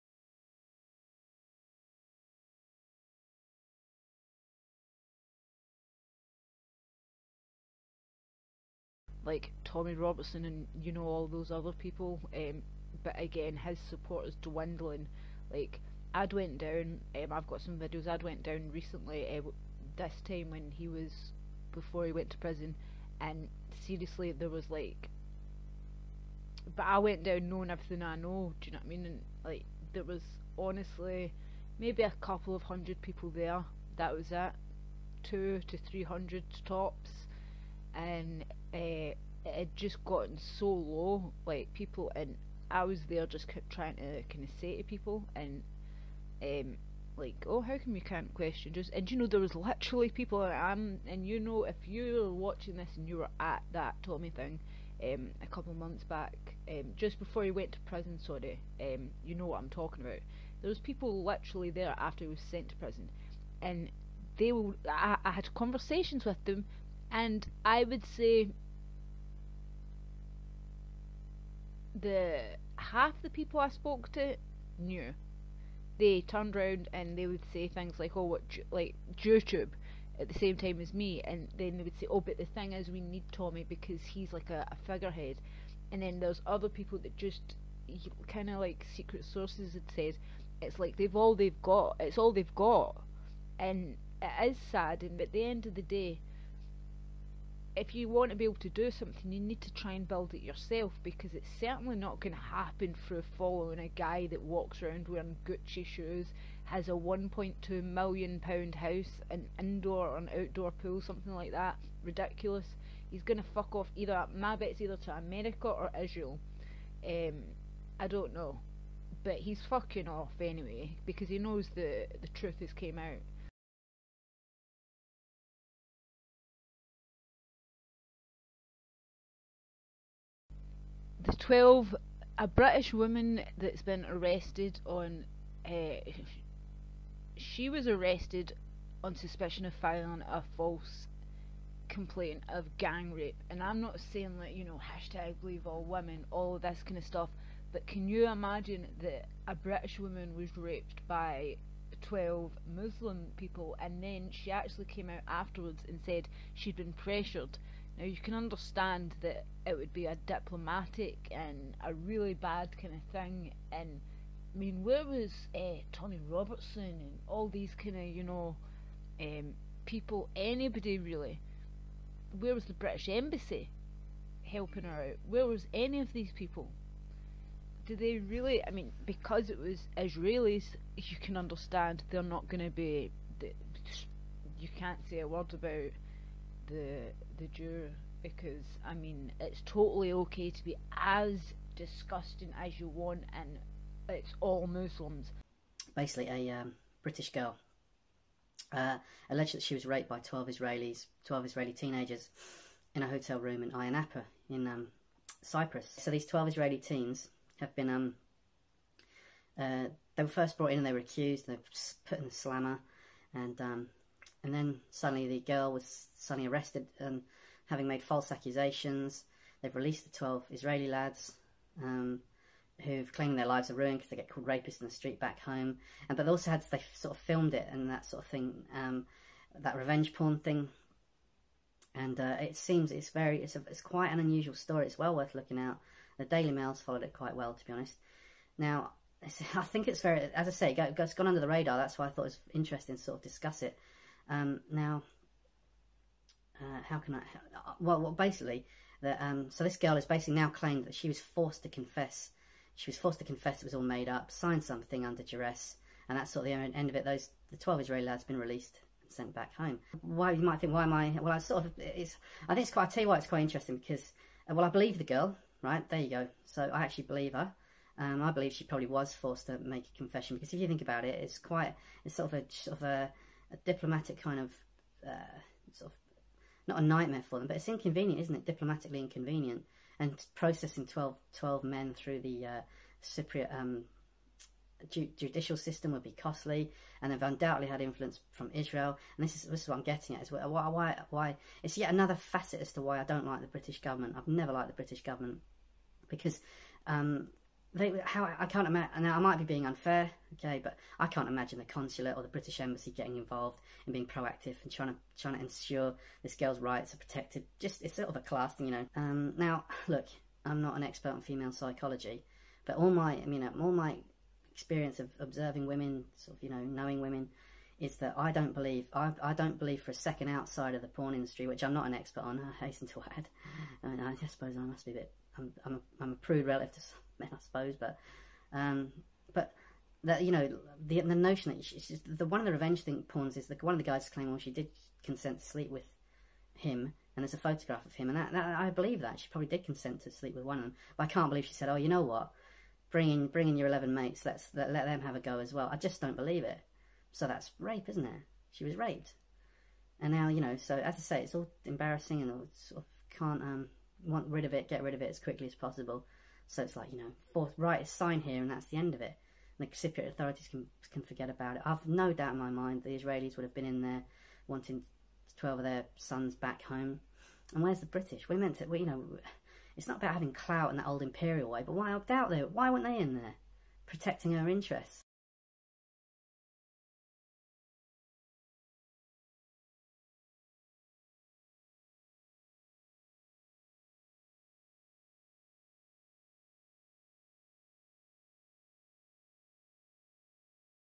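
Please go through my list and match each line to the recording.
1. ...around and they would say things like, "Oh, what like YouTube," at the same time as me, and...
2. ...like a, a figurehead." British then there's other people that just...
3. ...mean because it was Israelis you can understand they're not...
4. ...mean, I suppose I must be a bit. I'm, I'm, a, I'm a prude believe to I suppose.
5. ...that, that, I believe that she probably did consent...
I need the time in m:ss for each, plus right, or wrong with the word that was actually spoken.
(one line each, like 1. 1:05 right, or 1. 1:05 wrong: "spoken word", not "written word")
1. 1:16 right
2. 1:24 wrong: "And", not "British"
3. 2:58 right
4. 5:23 wrong: "relative", not "believe"
5. 5:38 right.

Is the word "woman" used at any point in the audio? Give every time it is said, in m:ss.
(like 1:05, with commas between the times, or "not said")
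2:12, 2:29.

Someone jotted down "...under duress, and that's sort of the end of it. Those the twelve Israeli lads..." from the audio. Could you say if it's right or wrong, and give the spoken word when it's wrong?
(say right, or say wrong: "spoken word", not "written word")
right.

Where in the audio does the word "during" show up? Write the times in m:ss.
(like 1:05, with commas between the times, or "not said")
not said.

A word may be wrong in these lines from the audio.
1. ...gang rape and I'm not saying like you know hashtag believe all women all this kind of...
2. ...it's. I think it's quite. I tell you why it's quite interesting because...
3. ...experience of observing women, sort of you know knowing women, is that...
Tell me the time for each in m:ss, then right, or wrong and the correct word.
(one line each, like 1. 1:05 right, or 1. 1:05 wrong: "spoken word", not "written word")
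1. 2:22 right
2. 4:21 right
3. 5:14 right.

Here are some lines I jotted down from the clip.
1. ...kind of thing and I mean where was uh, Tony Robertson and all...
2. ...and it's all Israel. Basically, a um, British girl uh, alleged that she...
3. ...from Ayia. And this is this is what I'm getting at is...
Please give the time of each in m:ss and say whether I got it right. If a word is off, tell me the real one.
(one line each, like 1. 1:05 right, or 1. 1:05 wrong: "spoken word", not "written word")
1. 2:42 right
2. 3:13 wrong: "Muslims", not "Israel"
3. 4:48 wrong: "Israel", not "Ayia".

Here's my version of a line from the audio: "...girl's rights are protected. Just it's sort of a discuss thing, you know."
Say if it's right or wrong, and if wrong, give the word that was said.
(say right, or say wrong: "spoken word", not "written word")
wrong: "class", not "discuss".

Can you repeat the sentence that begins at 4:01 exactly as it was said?
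That's why I thought it was interesting to sort of discuss it.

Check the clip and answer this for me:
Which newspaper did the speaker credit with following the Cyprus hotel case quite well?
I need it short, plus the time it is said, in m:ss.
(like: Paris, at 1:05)
The Daily Mail, at 3:56.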